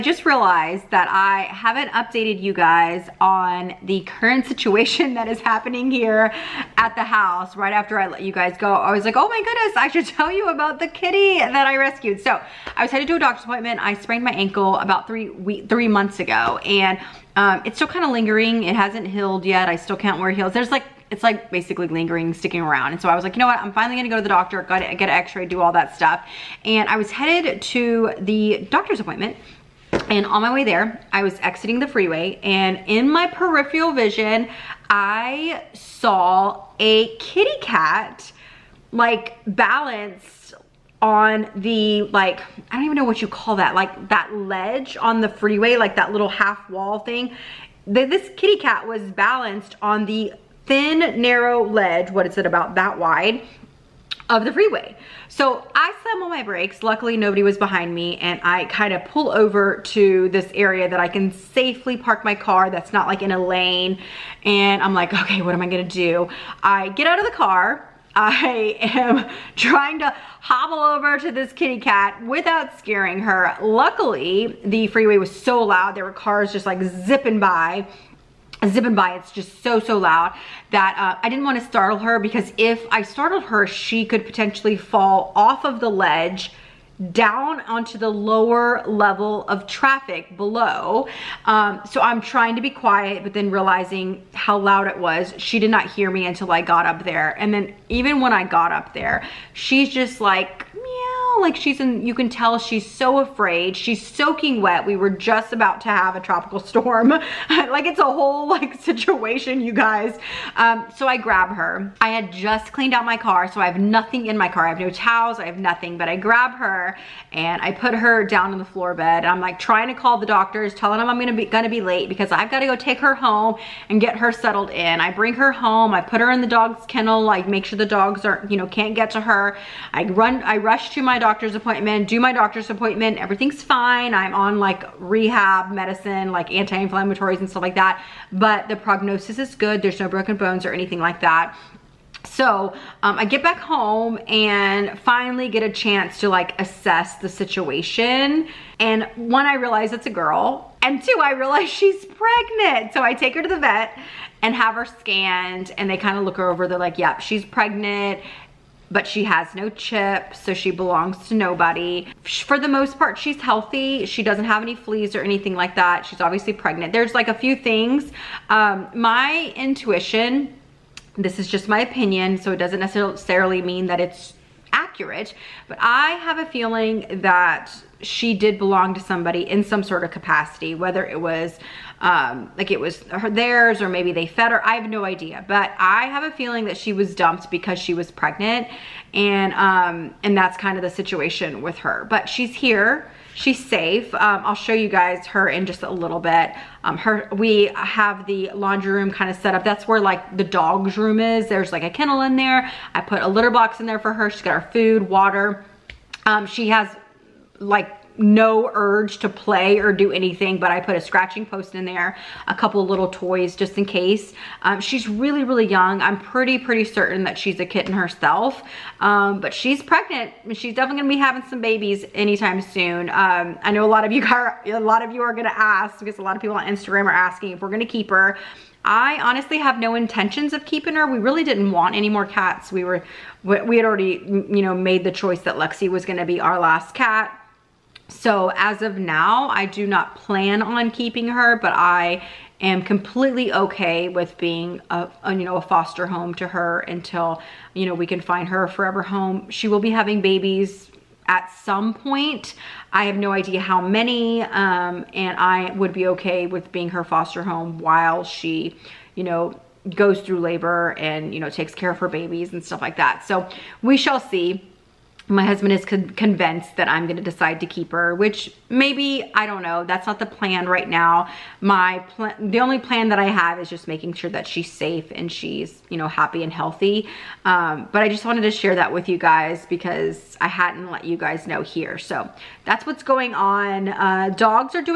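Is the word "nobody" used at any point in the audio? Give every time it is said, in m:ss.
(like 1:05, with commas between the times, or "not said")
0:57, 2:41.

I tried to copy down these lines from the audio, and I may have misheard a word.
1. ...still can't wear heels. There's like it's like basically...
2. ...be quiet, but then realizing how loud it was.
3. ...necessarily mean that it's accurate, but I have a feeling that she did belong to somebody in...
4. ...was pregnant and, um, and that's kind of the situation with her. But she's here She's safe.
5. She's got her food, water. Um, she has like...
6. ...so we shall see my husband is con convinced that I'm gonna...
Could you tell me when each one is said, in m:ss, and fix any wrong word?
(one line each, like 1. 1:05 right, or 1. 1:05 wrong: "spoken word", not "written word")
1. 0:19 right
2. 1:32 right
3. 2:52 right
4. 3:07 right
5. 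3:24 right
6. 4:23 right.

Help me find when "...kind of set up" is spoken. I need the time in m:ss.
3:19.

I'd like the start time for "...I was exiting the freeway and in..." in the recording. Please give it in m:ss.
0:31.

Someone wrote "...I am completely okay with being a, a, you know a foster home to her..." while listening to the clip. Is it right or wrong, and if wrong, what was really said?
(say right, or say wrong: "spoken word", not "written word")
right.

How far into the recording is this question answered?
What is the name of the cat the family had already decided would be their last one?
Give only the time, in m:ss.
3:55.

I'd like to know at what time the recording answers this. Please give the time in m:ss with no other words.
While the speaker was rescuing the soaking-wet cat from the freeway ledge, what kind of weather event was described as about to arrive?
1:46.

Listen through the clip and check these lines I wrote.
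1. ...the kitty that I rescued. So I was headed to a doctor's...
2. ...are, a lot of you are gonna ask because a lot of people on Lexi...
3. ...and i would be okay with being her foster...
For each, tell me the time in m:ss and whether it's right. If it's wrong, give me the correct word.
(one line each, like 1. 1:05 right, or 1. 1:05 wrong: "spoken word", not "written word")
1. 0:10 right
2. 3:44 wrong: "Instagram", not "Lexi"
3. 4:15 right.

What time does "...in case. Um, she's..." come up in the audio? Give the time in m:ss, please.
3:33.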